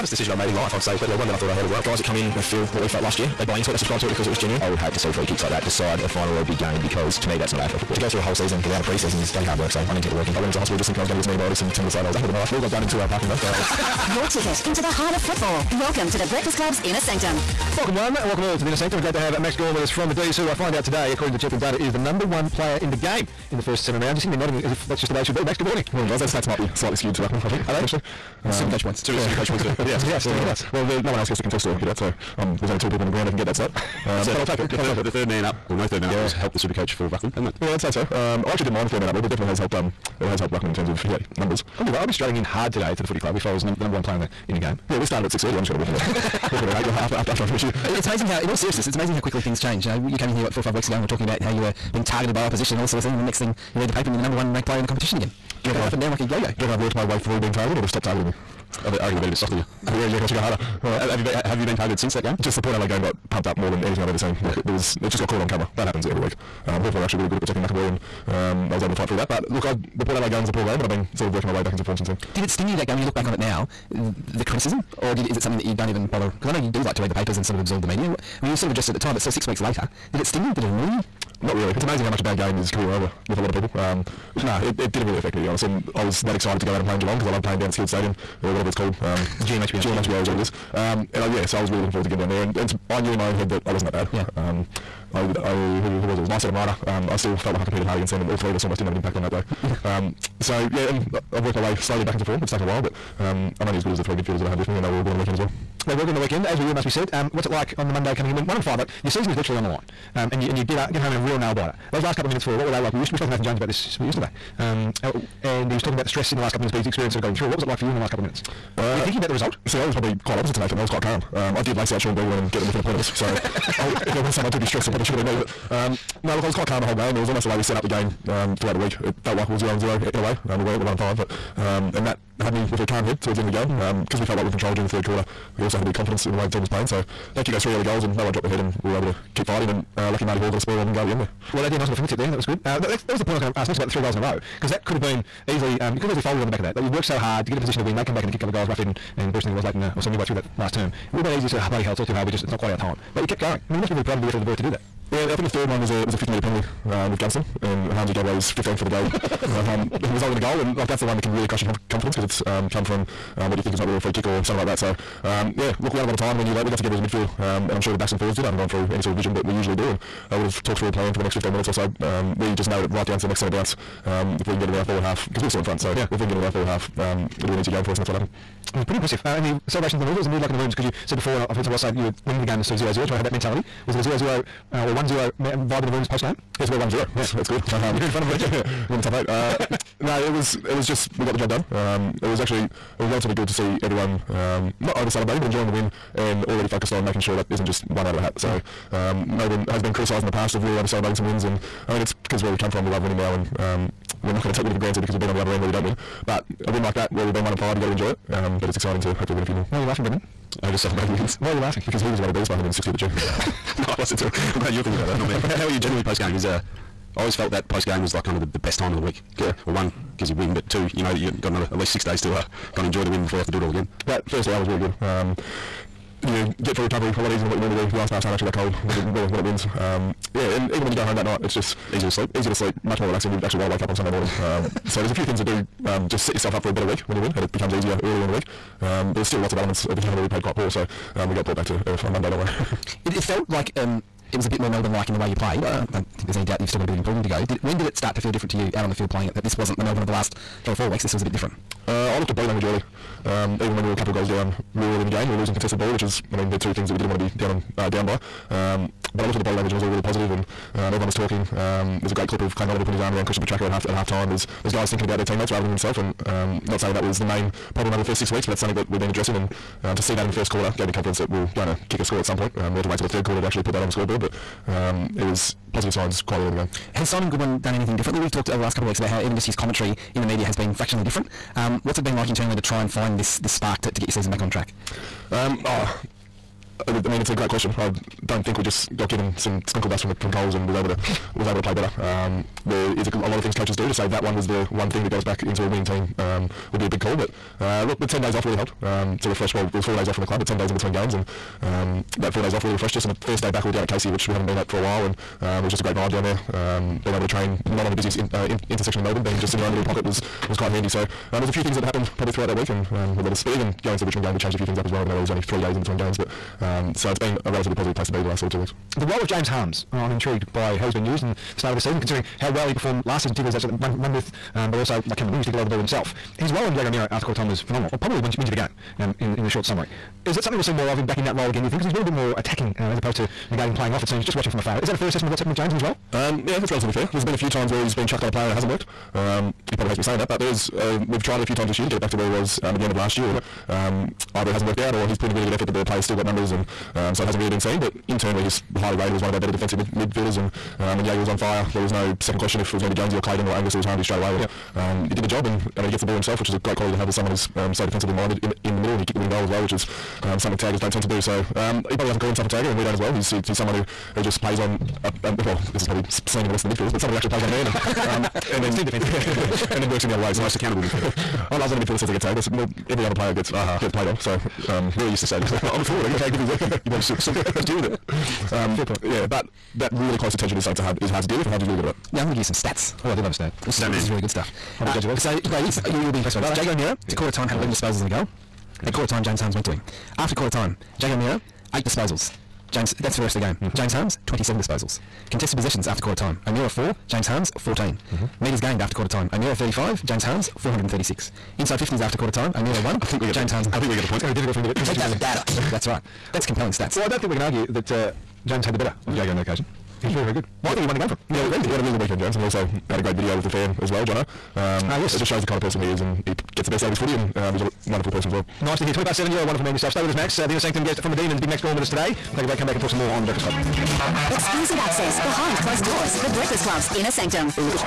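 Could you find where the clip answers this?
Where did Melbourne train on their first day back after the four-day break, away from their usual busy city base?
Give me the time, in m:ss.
5:03.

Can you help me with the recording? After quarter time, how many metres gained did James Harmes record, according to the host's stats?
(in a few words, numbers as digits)
436.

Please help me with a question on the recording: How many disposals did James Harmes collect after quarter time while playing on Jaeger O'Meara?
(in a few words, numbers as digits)
27.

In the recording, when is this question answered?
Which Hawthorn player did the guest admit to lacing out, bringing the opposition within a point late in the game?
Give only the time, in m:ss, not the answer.
2:01.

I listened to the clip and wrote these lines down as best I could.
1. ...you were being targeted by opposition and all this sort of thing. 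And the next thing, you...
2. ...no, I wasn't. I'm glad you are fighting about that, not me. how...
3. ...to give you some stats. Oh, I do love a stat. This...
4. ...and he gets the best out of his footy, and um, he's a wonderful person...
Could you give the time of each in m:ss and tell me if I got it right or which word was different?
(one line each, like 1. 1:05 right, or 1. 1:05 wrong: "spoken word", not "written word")
1. 0:51 right
2. 3:33 wrong: "thinking", not "fighting"
3. 6:22 right
4. 6:56 right.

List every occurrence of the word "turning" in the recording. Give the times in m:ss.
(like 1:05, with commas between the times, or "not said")
not said.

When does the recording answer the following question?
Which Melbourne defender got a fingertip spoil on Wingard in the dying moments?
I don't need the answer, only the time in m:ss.
2:20.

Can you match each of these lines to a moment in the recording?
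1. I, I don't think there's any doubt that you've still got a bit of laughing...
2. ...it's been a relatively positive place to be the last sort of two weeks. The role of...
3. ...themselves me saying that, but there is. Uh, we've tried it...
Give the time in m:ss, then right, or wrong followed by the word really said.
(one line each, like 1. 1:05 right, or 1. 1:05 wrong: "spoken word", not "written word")
1. 4:05 wrong: "improving", not "laughing"
2. 5:17 right
3. 5:39 wrong: "hates", not "themselves".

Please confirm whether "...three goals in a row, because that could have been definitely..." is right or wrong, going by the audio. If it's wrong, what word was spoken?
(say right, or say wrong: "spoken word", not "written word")
wrong: "easily", not "definitely".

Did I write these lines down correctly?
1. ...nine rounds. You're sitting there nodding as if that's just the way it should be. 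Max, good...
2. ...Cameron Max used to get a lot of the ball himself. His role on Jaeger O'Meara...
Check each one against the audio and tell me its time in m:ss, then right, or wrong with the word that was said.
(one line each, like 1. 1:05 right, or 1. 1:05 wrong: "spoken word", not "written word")
1. 0:23 wrong: "seven", not "nine"
2. 5:25 wrong: "Ling", not "Max".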